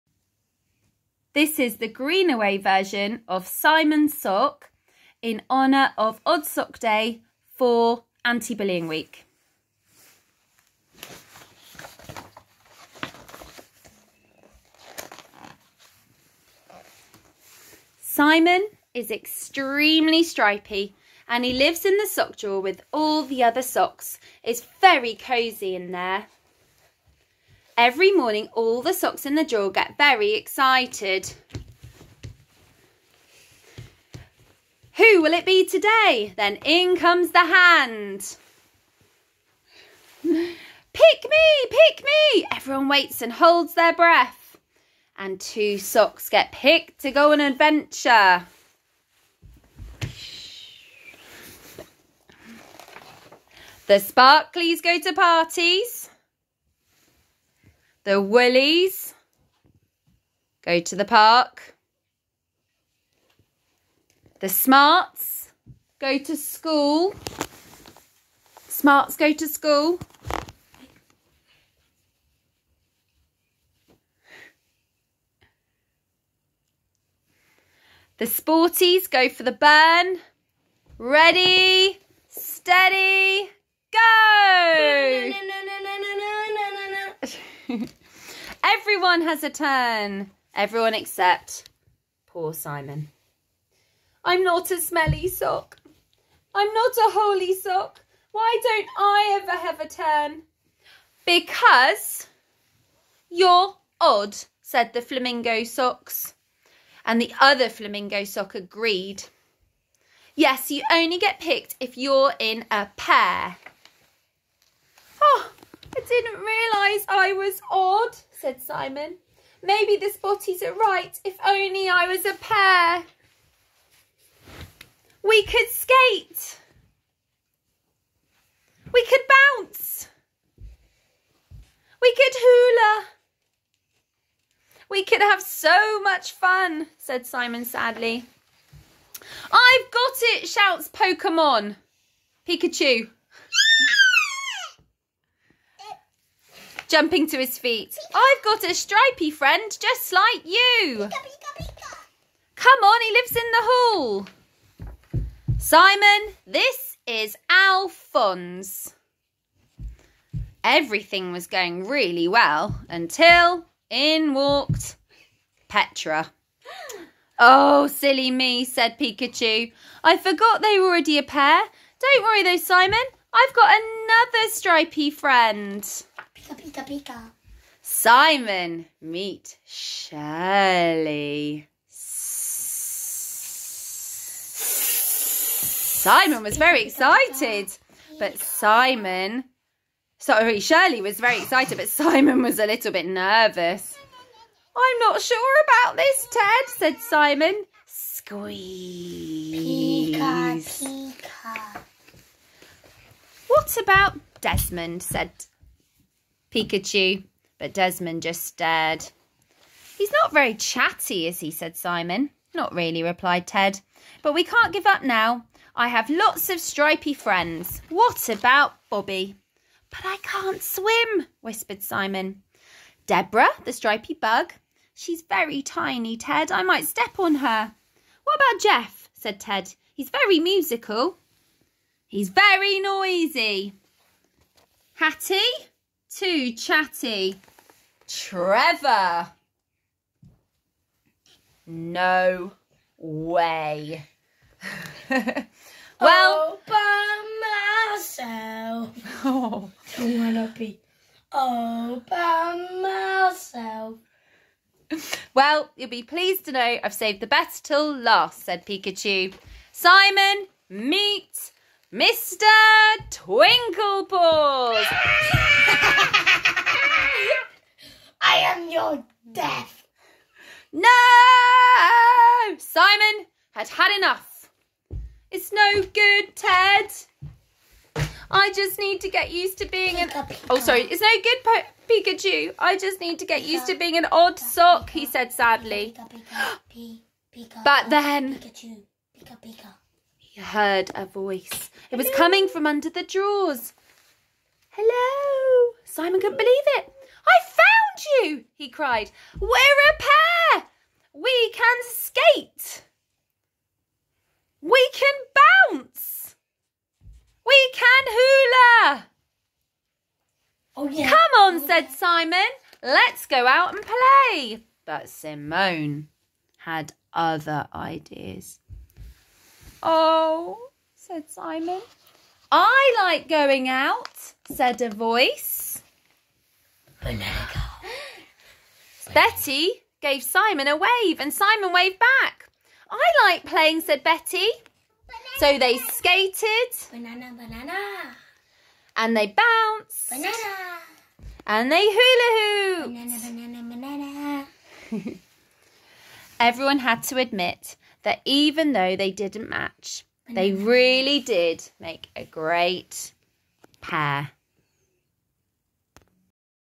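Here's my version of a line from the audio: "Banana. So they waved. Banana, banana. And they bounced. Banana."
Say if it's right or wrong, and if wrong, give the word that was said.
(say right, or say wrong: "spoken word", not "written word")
wrong: "skated", not "waved".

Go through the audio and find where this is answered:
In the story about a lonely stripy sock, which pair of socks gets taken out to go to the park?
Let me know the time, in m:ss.
0:58.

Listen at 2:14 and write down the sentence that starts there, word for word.
We could have so much fun, said Simon sadly.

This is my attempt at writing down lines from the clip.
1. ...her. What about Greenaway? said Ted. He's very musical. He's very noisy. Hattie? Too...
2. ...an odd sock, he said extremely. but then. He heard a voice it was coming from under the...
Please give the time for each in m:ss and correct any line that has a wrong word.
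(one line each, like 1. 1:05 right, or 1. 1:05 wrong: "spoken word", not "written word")
1. 3:47 wrong: "Jeff", not "Greenaway"
2. 4:43 wrong: "sadly", not "extremely".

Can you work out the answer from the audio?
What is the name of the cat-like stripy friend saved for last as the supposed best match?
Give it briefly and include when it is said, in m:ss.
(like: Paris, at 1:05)
Mr. Twinklepaws, at 4:21.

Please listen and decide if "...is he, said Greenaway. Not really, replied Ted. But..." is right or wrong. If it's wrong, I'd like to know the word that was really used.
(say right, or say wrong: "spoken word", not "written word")
wrong: "Simon", not "Greenaway".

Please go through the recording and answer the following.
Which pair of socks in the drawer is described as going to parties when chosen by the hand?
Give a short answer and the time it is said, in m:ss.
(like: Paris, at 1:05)
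The Sparklies, at 0:53.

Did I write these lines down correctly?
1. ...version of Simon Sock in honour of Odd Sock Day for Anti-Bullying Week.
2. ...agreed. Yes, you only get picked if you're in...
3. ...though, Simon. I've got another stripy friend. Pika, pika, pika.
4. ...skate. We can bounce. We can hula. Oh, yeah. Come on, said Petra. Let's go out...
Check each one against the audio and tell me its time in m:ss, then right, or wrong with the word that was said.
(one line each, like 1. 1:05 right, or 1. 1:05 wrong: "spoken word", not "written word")
1. 0:02 right
2. 1:48 right
3. 2:52 right
4. 5:01 wrong: "Simon", not "Petra".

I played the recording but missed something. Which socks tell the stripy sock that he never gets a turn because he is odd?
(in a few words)
The flamingo socks.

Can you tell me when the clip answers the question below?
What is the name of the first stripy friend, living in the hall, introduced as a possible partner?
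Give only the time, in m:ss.
2:37.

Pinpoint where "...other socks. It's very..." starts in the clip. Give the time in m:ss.
0:23.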